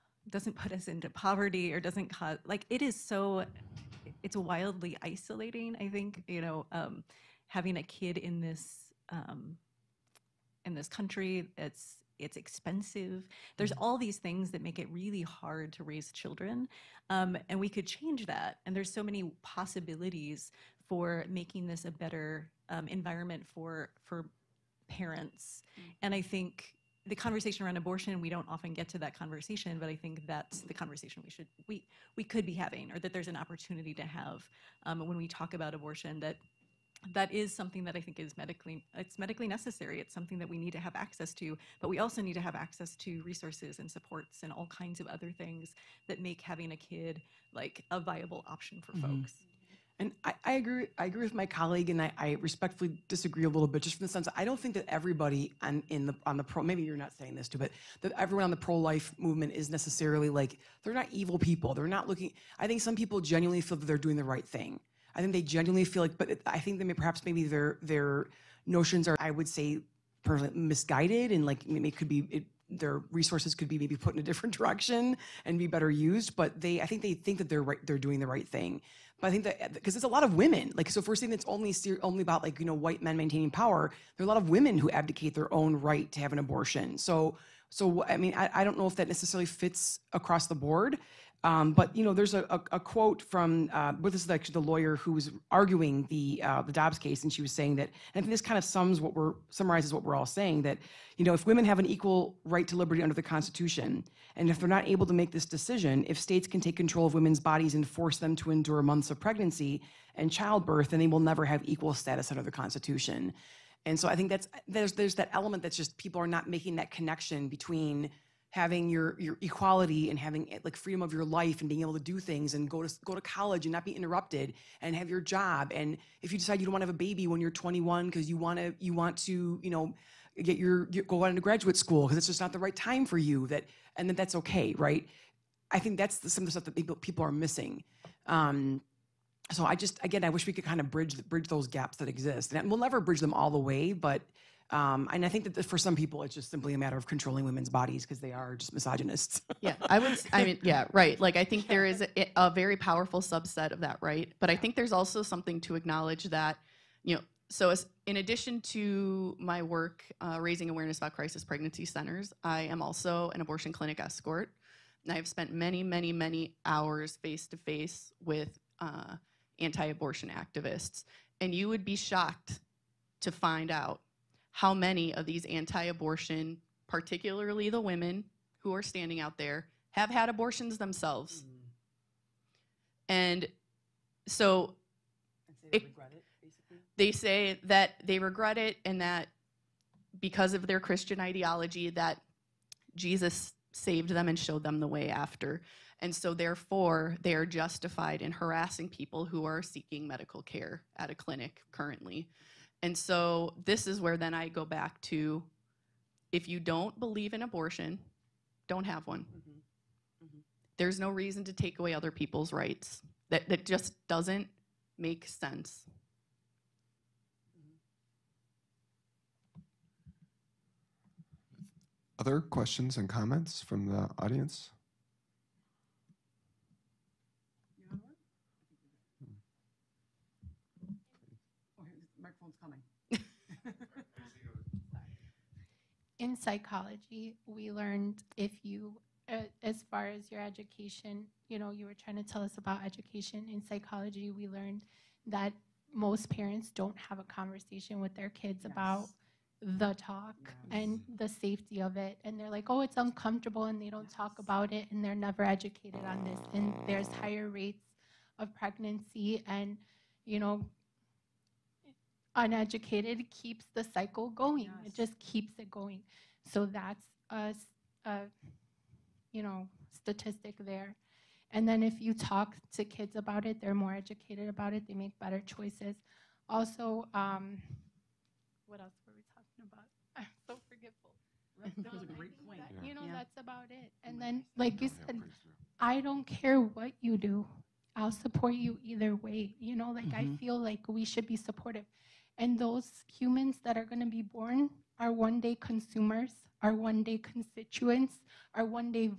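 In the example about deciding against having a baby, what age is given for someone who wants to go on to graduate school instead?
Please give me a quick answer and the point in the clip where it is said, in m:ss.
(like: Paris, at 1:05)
21, at 2:07.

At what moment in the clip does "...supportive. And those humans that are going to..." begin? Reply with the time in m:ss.
4:51.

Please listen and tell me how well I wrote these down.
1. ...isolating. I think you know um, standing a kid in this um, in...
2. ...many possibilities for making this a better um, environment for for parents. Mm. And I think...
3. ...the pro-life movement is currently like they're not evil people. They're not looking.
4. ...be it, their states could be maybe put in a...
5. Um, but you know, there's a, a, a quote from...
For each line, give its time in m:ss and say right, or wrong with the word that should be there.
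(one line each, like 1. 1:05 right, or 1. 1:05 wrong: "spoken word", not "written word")
1. 0:05 wrong: "having", not "standing"
2. 0:19 right
3. 0:58 wrong: "necessarily", not "currently"
4. 1:12 wrong: "resources", not "states"
5. 1:31 right.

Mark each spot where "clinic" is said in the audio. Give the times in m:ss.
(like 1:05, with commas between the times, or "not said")
2:43, 3:21.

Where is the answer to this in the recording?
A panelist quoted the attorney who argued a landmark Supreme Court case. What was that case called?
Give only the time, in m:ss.
1:36.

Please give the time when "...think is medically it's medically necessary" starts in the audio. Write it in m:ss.
0:38.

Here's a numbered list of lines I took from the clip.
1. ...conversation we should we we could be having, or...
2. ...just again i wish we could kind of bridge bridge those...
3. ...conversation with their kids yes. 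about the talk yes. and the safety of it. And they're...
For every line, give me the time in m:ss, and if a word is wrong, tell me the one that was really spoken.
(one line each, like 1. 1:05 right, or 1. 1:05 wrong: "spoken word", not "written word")
1. 0:30 right
2. 2:19 right
3. 4:07 right.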